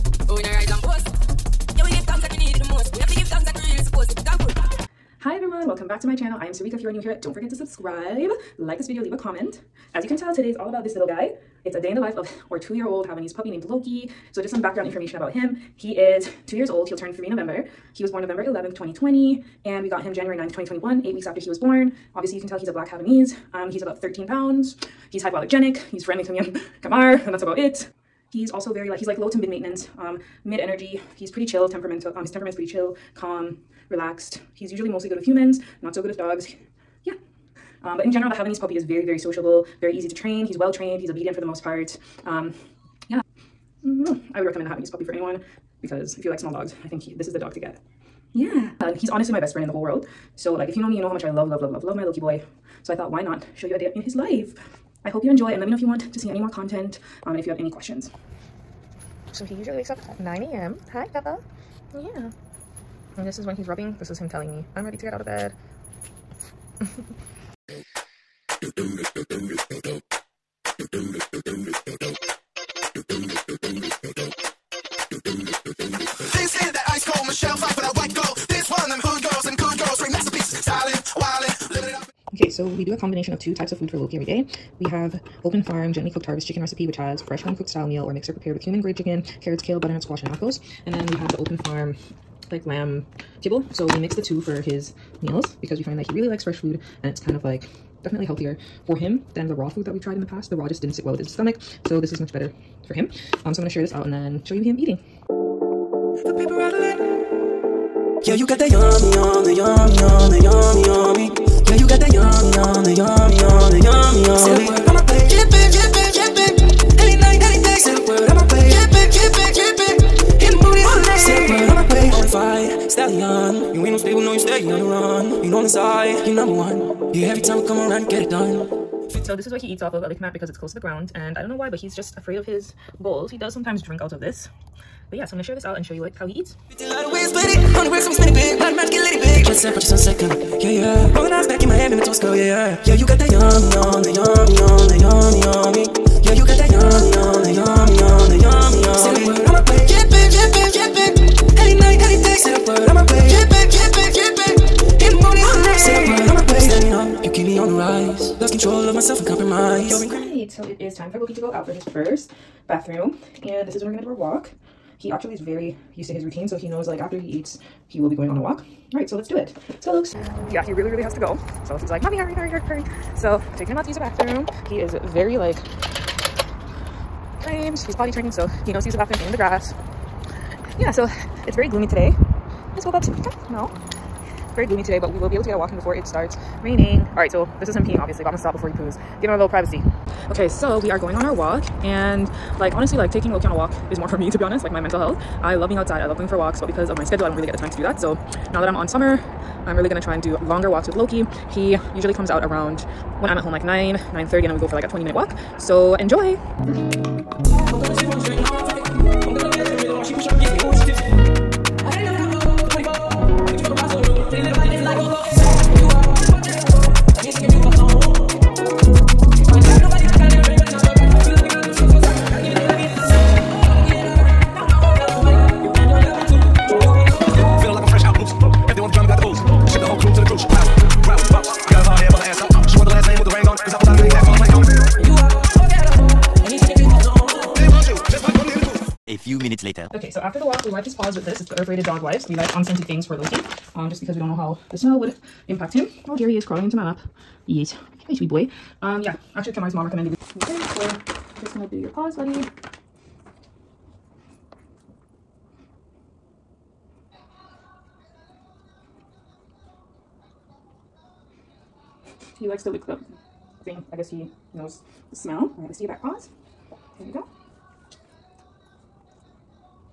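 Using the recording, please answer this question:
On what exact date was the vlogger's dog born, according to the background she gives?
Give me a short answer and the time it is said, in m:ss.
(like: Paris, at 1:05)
November 11th, 2020, at 0:18.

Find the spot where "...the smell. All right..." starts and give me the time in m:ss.
4:25.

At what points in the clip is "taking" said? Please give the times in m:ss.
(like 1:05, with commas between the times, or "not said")
2:53, 3:13.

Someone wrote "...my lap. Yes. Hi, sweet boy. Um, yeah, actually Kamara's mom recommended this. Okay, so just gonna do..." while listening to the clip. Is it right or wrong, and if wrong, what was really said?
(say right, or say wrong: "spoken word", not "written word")
right.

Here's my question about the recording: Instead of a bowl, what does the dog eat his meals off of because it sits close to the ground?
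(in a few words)
A lick mat.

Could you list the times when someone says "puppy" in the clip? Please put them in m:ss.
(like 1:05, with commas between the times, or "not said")
0:13, 0:38, 0:44.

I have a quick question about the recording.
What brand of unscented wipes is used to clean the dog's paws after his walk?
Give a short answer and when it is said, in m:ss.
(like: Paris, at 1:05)
Earth Rated, at 4:01.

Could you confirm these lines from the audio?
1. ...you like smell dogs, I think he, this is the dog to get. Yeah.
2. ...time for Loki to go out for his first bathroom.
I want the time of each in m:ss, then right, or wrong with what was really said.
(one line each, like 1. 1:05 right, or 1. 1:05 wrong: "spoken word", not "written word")
1. 0:46 wrong: "small", not "smell"
2. 2:41 right.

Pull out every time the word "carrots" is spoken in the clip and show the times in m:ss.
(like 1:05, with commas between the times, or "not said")
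1:29.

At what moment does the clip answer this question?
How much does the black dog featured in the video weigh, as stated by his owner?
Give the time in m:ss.
0:24.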